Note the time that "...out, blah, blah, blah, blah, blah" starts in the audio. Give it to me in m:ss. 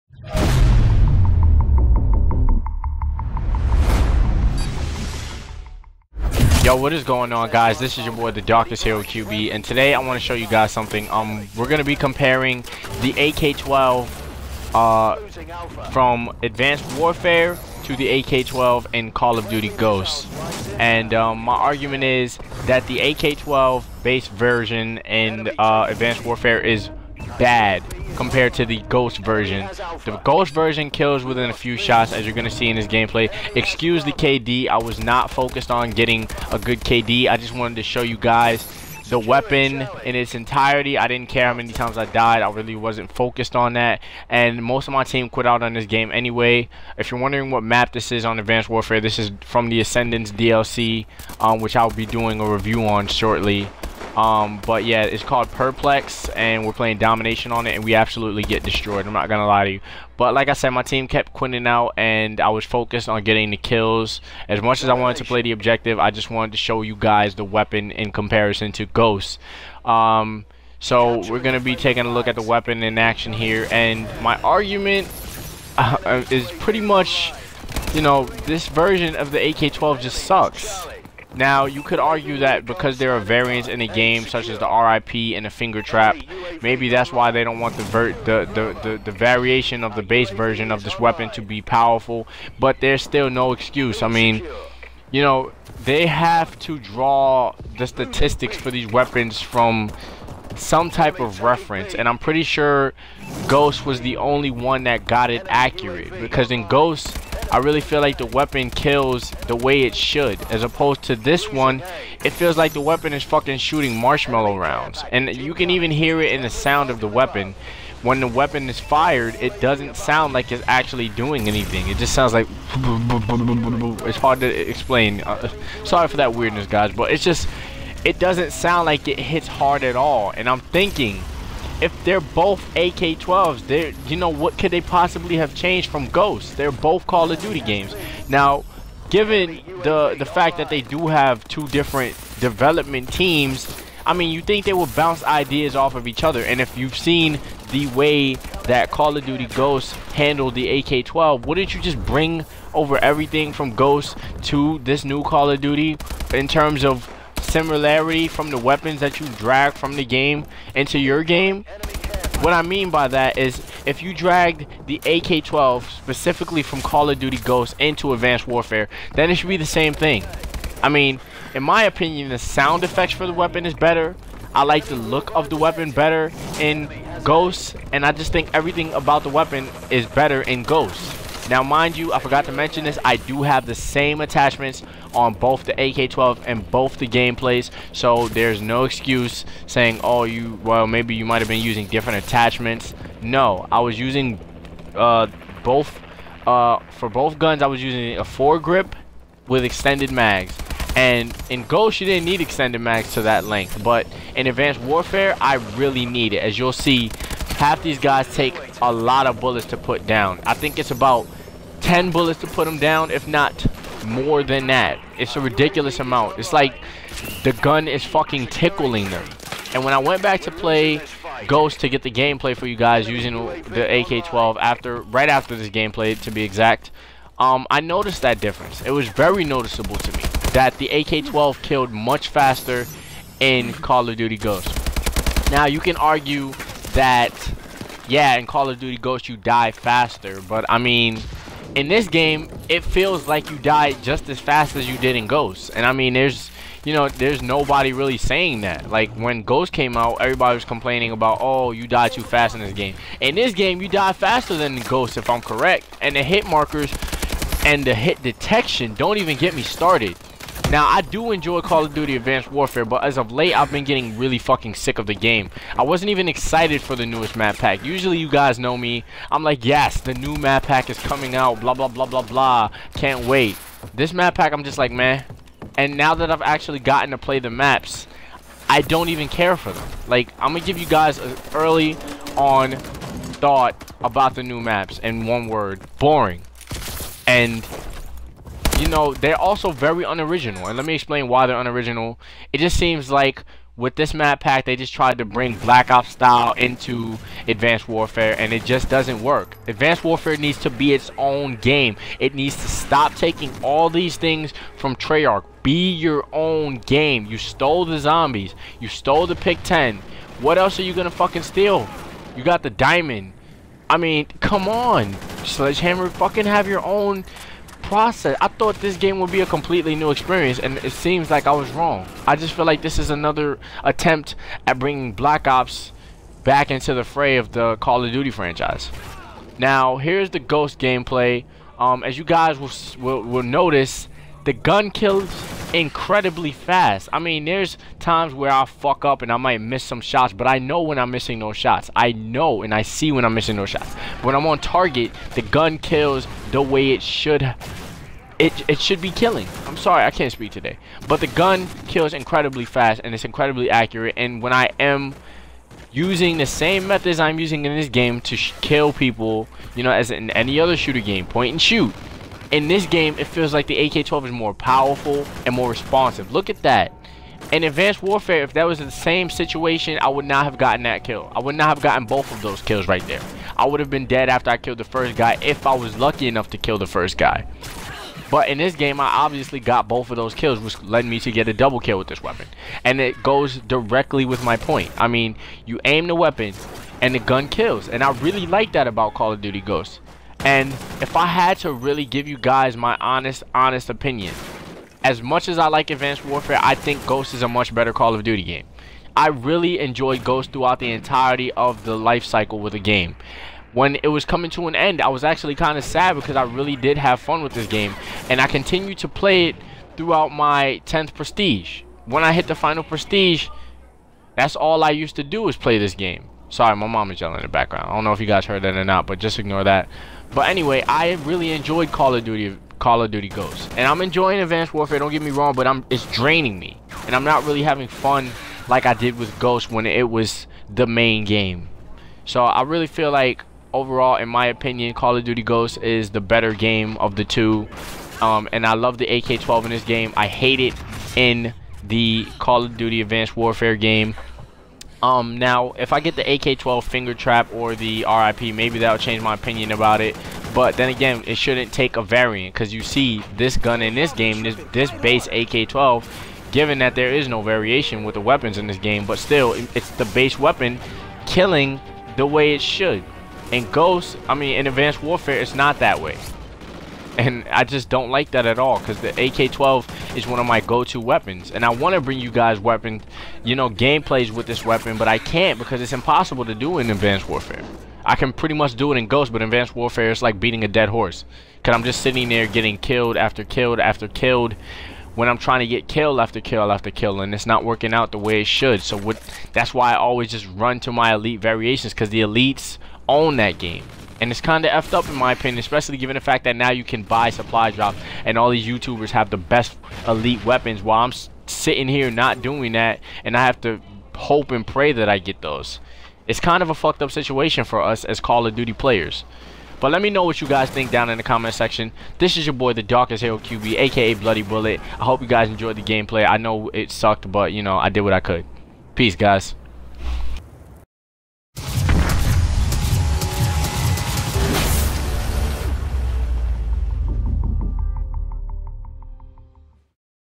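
4:31.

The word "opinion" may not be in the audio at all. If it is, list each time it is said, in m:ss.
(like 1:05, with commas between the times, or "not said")
2:51, 6:33, 7:14, 7:29, 8:15.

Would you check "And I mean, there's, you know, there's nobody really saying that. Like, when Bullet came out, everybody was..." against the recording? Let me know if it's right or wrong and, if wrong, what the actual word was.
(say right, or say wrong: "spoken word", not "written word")
wrong: "Ghost", not "Bullet".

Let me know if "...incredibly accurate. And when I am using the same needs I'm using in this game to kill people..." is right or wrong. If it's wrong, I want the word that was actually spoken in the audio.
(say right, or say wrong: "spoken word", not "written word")
wrong: "methods", not "needs".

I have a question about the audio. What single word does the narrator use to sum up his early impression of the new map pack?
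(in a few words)
Boring.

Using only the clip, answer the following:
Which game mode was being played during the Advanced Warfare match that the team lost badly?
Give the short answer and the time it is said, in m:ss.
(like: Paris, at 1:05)
Domination, at 0:56.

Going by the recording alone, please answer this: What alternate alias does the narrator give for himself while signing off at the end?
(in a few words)
Bloody Bullet.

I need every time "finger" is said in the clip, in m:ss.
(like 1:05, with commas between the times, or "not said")
1:25, 7:26.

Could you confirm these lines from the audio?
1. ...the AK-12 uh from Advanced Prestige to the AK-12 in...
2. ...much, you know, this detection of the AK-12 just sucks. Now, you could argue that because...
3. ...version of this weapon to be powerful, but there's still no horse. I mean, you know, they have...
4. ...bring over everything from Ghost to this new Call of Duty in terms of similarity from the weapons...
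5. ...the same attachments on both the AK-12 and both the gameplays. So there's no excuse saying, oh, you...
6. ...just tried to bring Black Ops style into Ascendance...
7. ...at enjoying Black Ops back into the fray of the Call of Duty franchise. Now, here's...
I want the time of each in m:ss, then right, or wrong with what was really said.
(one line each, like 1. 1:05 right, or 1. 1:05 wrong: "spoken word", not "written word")
1. 0:13 wrong: "Warfare", not "Prestige"
2. 1:16 wrong: "version", not "detection"
3. 1:30 wrong: "excuse", not "horse"
4. 2:32 right
5. 3:03 right
6. 4:54 wrong: "Advanced", not "Ascendance"
7. 5:24 wrong: "bringing", not "enjoying".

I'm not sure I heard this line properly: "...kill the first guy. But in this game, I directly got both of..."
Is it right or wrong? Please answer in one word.
wrong.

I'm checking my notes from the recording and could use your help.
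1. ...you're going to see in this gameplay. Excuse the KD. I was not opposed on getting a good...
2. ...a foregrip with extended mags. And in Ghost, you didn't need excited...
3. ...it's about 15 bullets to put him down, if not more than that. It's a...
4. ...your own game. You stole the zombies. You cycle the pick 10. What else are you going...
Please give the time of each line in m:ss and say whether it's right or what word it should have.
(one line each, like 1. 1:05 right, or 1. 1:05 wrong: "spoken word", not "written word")
1. 0:32 wrong: "focused", not "opposed"
2. 3:18 wrong: "extended", not "excited"
3. 3:30 wrong: "10", not "15"
4. 5:05 wrong: "stole", not "cycle".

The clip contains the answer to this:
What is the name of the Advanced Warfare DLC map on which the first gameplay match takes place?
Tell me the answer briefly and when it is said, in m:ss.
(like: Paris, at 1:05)
Perplex, at 0:55.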